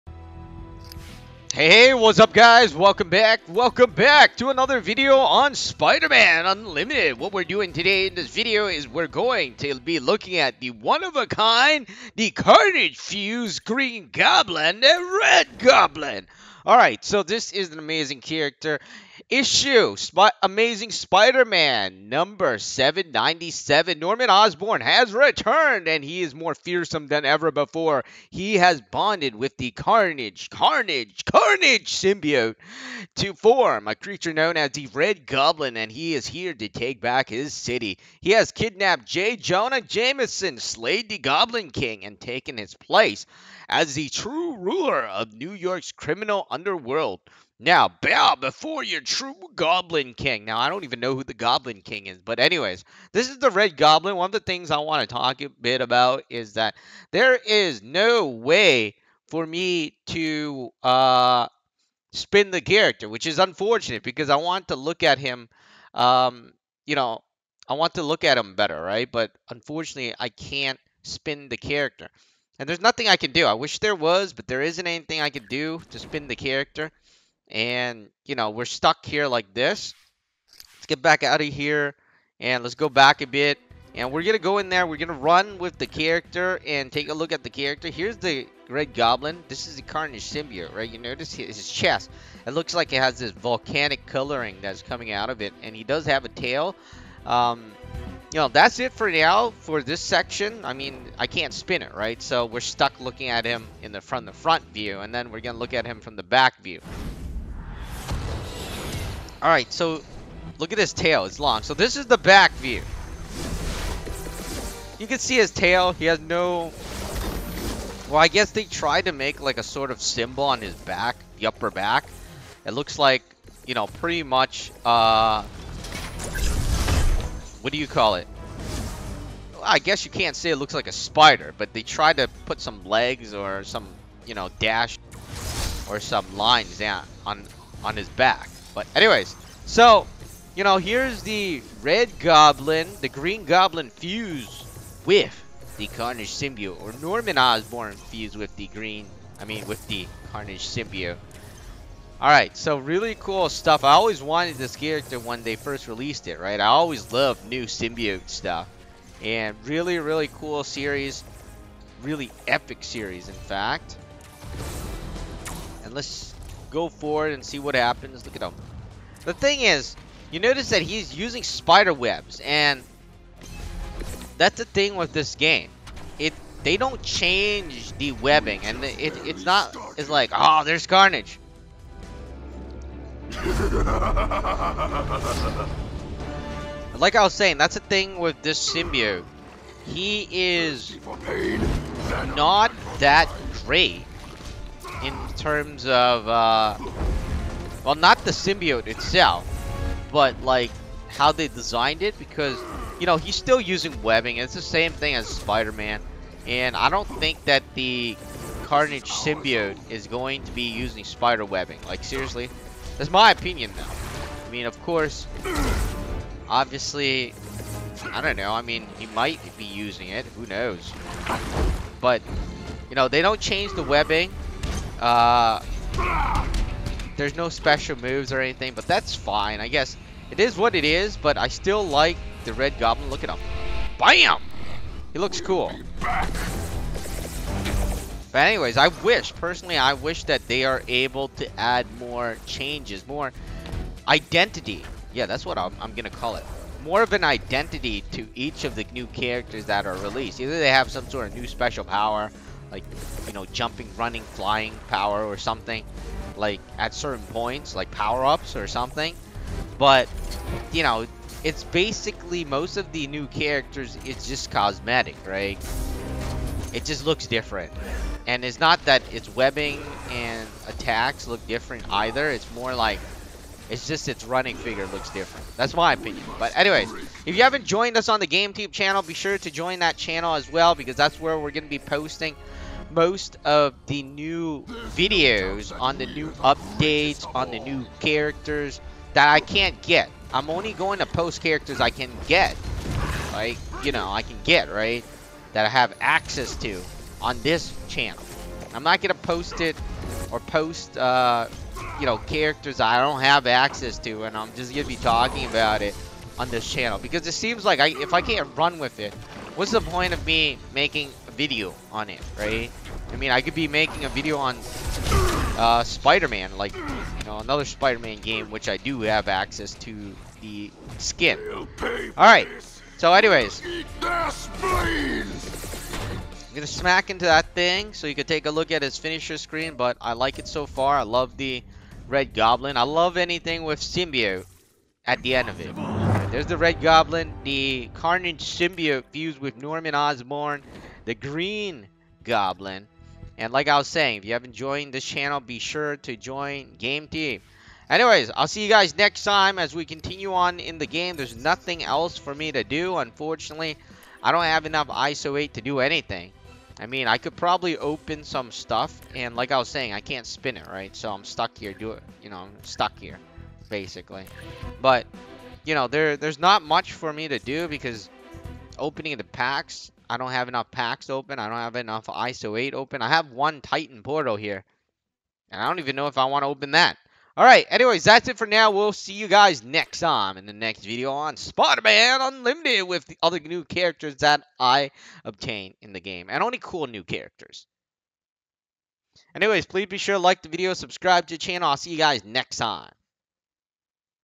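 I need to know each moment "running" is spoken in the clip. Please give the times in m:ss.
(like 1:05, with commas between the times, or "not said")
4:13, 4:34.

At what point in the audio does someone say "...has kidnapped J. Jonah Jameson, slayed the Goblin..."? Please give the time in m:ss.
0:38.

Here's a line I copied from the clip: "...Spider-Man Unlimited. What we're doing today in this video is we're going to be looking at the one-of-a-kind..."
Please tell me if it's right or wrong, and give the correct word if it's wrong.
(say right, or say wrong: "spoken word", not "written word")
right.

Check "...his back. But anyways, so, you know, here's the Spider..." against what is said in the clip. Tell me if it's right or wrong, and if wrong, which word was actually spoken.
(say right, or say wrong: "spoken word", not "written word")
wrong: "Red", not "Spider".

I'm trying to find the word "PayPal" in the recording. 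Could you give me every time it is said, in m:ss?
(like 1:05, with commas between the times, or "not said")
not said.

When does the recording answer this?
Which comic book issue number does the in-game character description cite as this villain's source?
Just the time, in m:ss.
0:22.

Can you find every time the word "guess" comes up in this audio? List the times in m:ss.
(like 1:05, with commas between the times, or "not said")
1:58, 2:09, 3:49.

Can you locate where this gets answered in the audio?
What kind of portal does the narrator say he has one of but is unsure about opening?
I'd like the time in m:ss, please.
6:13.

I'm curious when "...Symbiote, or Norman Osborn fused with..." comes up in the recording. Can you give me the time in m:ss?
2:26.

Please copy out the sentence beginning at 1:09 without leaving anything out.
But unfortunately, I can't spin the character.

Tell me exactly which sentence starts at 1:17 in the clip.
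And, you know, we're stuck here like this.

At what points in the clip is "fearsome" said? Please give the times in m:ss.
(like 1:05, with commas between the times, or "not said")
0:26.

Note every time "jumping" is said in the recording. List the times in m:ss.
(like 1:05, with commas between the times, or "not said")
4:13.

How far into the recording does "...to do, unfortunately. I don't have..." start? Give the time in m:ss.
5:52.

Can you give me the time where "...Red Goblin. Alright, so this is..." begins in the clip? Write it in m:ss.
0:15.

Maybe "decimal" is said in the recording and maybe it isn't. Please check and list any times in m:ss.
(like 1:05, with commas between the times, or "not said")
not said.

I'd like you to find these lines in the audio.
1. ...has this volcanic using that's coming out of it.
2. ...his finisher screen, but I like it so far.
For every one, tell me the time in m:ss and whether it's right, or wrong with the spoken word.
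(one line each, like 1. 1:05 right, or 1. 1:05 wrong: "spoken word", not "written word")
1. 1:33 wrong: "coloring", not "using"
2. 5:28 right.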